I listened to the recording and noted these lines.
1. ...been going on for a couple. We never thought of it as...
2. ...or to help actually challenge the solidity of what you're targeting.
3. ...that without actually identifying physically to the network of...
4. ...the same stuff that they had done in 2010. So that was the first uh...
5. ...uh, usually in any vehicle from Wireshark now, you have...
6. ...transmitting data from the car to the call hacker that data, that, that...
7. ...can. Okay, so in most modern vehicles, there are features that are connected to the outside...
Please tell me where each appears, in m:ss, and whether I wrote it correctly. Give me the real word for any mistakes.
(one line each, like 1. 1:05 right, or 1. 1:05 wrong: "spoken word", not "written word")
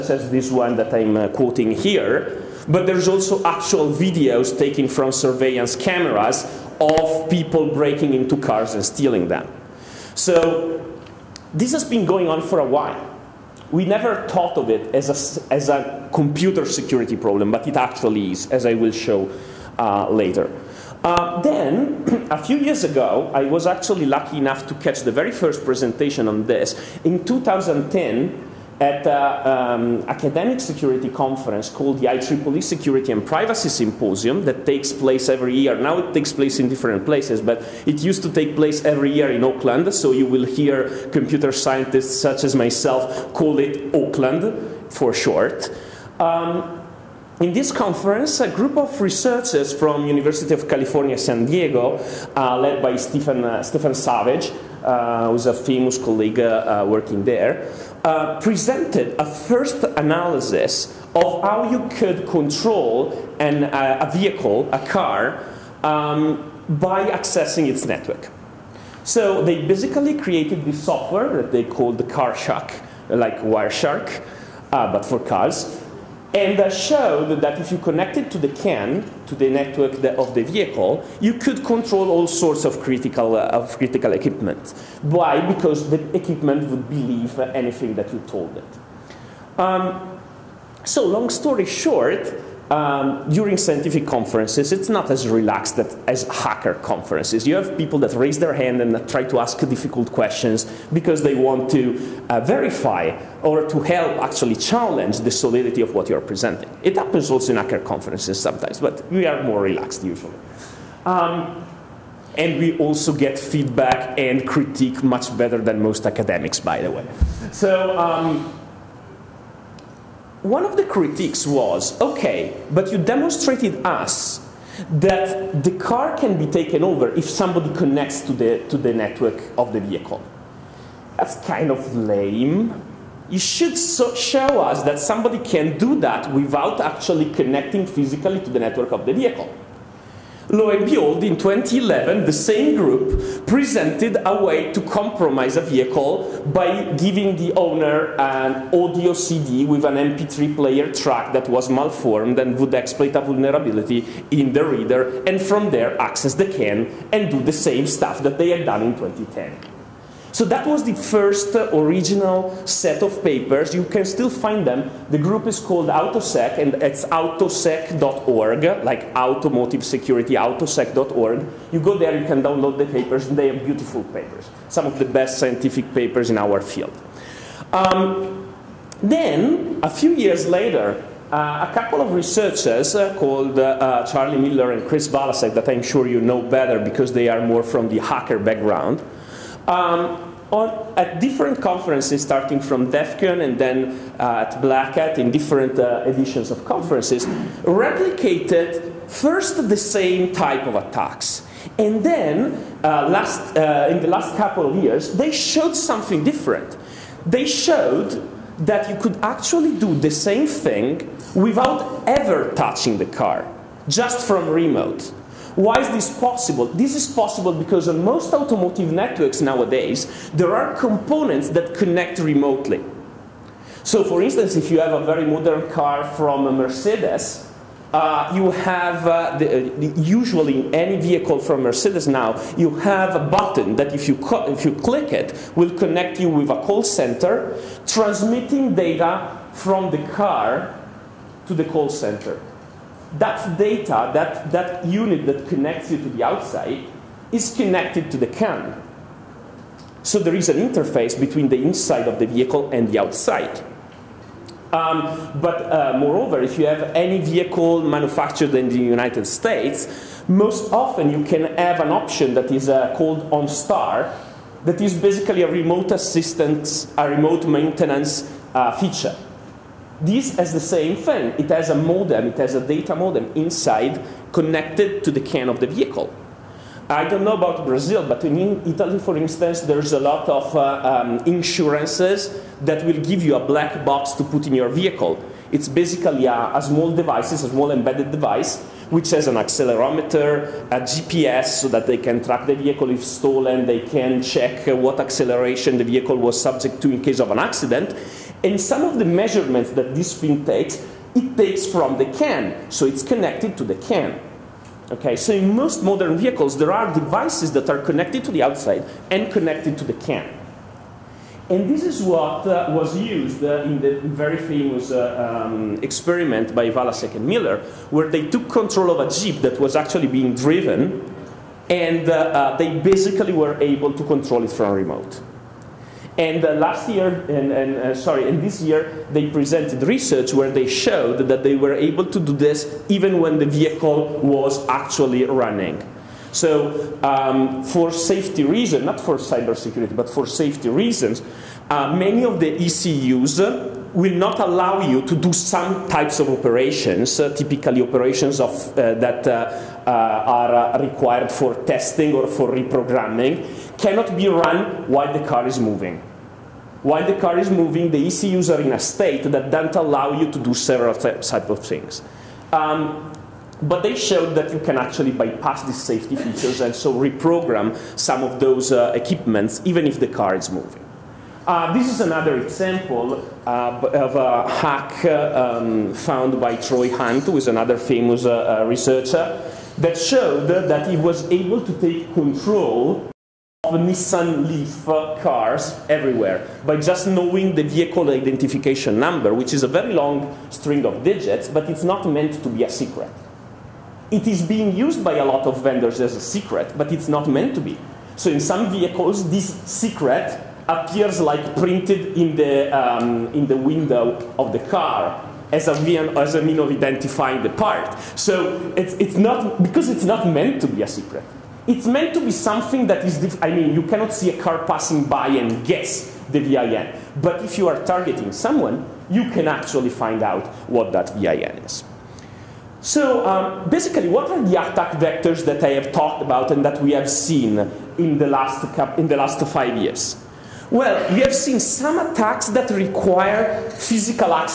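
1. 0:11 wrong: "while", not "couple"
2. 1:43 wrong: "presenting", not "targeting"
3. 2:16 wrong: "connecting", not "identifying"
4. 2:37 right
5. 3:49 wrong: "Mercedes", not "Wireshark"
6. 3:57 wrong: "center", not "hacker"
7. 5:03 wrong: "devices", not "features".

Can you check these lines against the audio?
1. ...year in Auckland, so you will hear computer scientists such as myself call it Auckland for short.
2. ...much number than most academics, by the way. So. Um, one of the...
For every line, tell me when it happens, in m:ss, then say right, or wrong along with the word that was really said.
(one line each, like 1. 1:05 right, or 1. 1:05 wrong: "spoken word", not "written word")
1. 0:39 right
2. 1:55 wrong: "better", not "number".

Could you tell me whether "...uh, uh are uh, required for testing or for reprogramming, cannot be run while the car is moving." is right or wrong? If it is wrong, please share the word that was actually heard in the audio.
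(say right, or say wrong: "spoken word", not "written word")
right.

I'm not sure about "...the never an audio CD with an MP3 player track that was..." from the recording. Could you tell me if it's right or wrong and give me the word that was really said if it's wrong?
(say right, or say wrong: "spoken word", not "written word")
wrong: "owner", not "never".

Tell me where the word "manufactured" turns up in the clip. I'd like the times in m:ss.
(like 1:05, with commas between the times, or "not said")
4:17.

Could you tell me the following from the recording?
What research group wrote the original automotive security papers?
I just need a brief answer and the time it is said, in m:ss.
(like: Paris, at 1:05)
AutoSec, at 2:45.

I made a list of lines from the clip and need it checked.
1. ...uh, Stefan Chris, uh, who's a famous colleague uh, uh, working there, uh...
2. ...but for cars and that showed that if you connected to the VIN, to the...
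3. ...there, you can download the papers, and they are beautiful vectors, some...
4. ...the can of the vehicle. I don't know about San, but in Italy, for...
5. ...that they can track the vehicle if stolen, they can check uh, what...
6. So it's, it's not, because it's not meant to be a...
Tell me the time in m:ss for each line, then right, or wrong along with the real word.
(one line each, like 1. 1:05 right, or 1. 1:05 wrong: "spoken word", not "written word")
1. 0:53 wrong: "Savage", not "Chris"
2. 1:14 wrong: "CAN", not "VIN"
3. 2:51 wrong: "papers", not "vectors"
4. 4:35 wrong: "Brazil", not "San"
5. 4:51 right
6. 6:48 right.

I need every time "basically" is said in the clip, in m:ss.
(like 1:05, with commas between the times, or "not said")
1:09, 4:24, 4:45, 5:22, 7:03.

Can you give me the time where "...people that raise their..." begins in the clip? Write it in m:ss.
1:37.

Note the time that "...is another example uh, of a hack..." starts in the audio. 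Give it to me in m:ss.
6:11.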